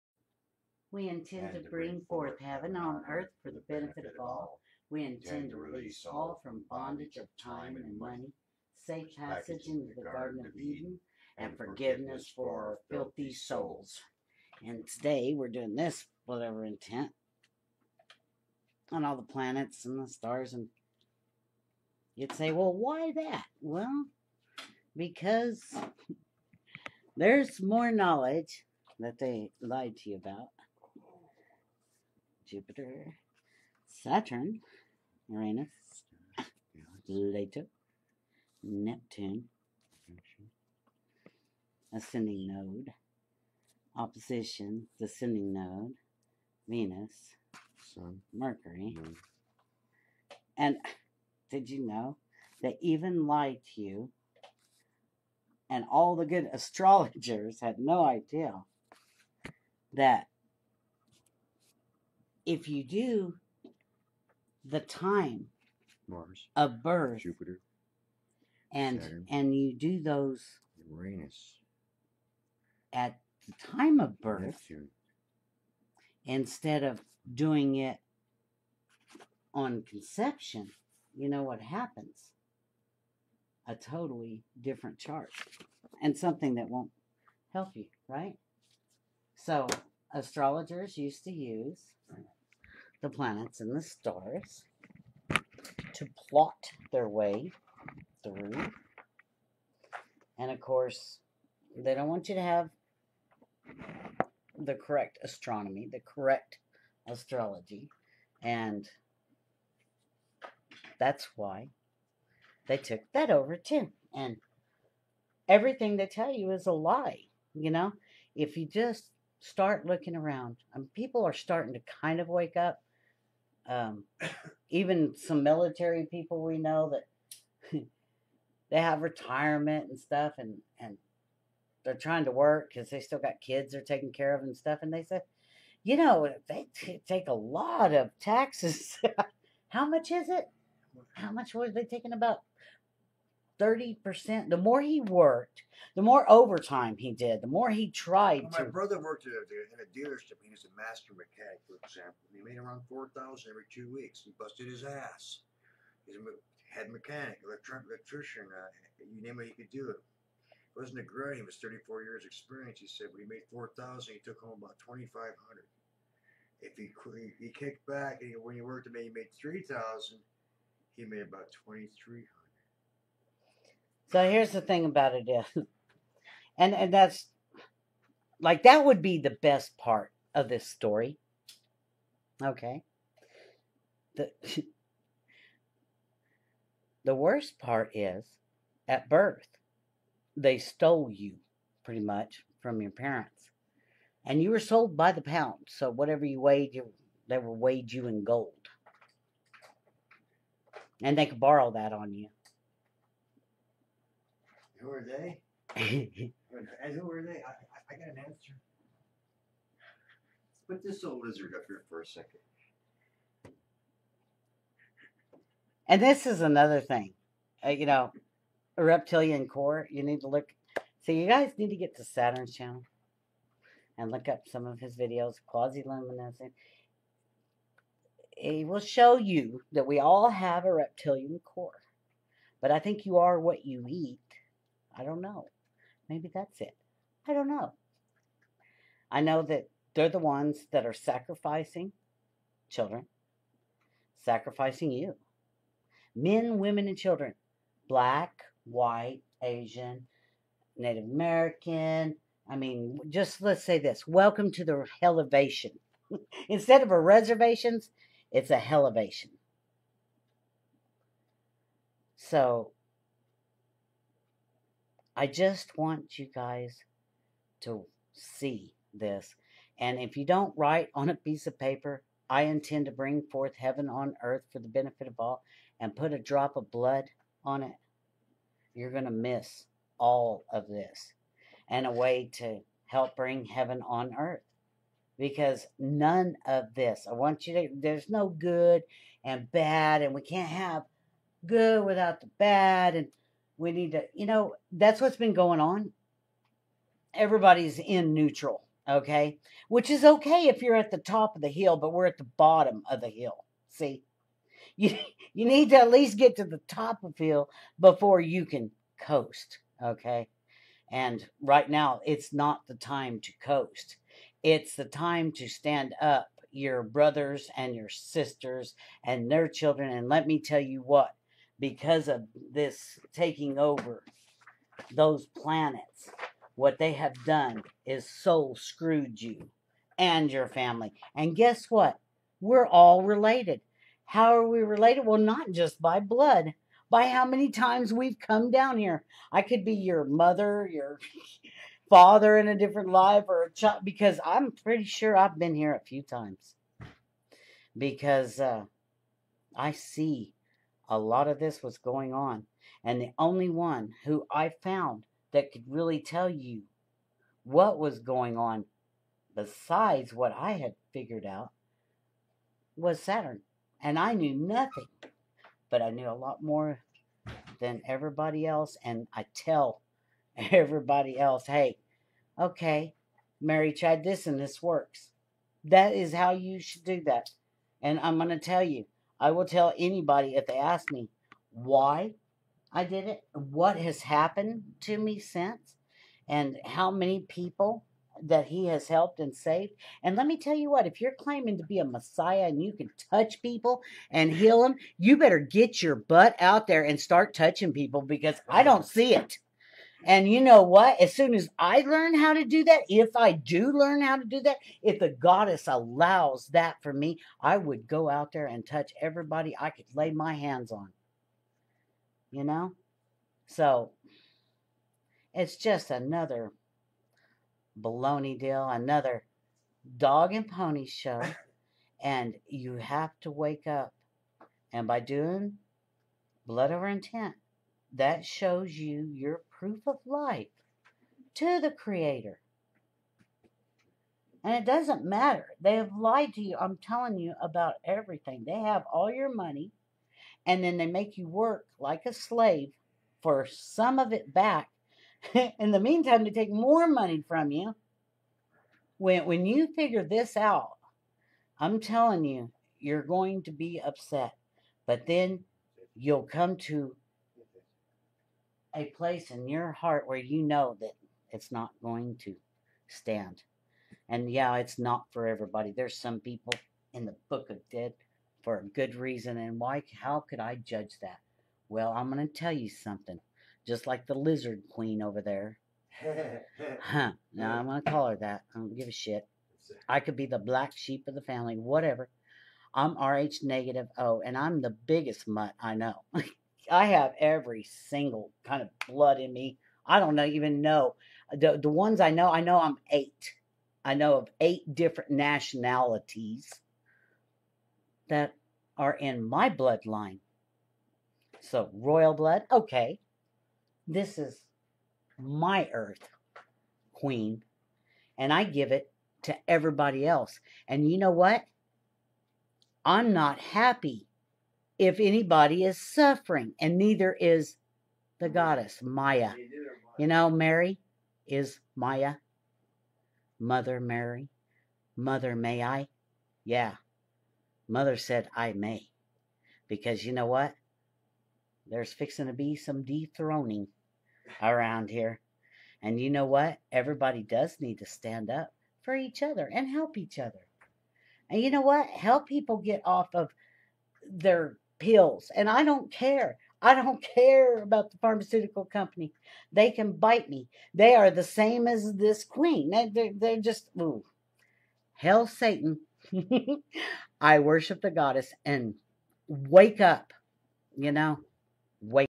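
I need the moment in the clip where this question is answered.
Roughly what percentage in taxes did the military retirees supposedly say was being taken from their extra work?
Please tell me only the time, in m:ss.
2:23.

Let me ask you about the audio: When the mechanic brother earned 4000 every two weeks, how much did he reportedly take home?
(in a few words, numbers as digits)
2500.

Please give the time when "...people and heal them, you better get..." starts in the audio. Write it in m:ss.
6:33.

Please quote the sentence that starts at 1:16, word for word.
instead of doing it on conception, you know what happens?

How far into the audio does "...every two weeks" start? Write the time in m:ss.
2:33.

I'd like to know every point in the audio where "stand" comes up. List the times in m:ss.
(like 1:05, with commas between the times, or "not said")
5:15, 7:42, 8:57.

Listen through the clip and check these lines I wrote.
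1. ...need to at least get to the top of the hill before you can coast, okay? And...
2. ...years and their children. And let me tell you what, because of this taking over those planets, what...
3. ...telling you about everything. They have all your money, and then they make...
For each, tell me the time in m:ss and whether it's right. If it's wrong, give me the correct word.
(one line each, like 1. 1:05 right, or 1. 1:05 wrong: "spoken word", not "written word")
1. 5:05 right
2. 5:17 wrong: "sisters", not "years"
3. 7:16 right.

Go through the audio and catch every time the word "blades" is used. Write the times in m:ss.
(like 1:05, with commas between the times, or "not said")
not said.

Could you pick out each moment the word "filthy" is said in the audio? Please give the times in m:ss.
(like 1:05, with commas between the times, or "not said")
0:12.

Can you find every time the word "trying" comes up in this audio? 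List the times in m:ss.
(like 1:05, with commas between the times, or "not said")
2:11.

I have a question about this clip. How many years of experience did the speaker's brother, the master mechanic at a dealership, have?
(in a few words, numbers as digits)
34.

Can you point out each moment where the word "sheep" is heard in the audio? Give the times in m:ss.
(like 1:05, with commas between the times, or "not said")
8:00.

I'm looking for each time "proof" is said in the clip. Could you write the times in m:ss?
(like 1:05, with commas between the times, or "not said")
7:09.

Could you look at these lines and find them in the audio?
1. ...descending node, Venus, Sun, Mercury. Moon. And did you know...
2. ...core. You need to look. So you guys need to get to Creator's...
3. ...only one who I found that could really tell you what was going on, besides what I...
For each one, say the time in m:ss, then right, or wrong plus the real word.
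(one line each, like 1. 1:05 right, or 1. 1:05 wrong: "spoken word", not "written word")
1. 0:44 right
2. 3:39 wrong: "Saturn", not "Creator"
3. 5:53 right.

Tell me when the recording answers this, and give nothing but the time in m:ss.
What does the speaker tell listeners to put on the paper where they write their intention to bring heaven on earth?
4:36.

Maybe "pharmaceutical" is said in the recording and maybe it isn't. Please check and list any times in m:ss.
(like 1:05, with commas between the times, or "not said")
9:07.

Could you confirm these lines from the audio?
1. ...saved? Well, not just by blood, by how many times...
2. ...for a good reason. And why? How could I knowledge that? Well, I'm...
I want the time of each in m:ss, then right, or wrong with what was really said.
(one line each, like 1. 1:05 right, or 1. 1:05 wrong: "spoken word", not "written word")
1. 5:34 wrong: "related", not "saved"
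2. 7:48 wrong: "judge", not "knowledge".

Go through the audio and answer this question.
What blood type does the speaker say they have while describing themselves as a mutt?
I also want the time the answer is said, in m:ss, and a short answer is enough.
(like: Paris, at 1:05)
RH negative O, at 8:03.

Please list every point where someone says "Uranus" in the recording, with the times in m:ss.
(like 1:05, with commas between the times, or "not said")
0:35, 1:10.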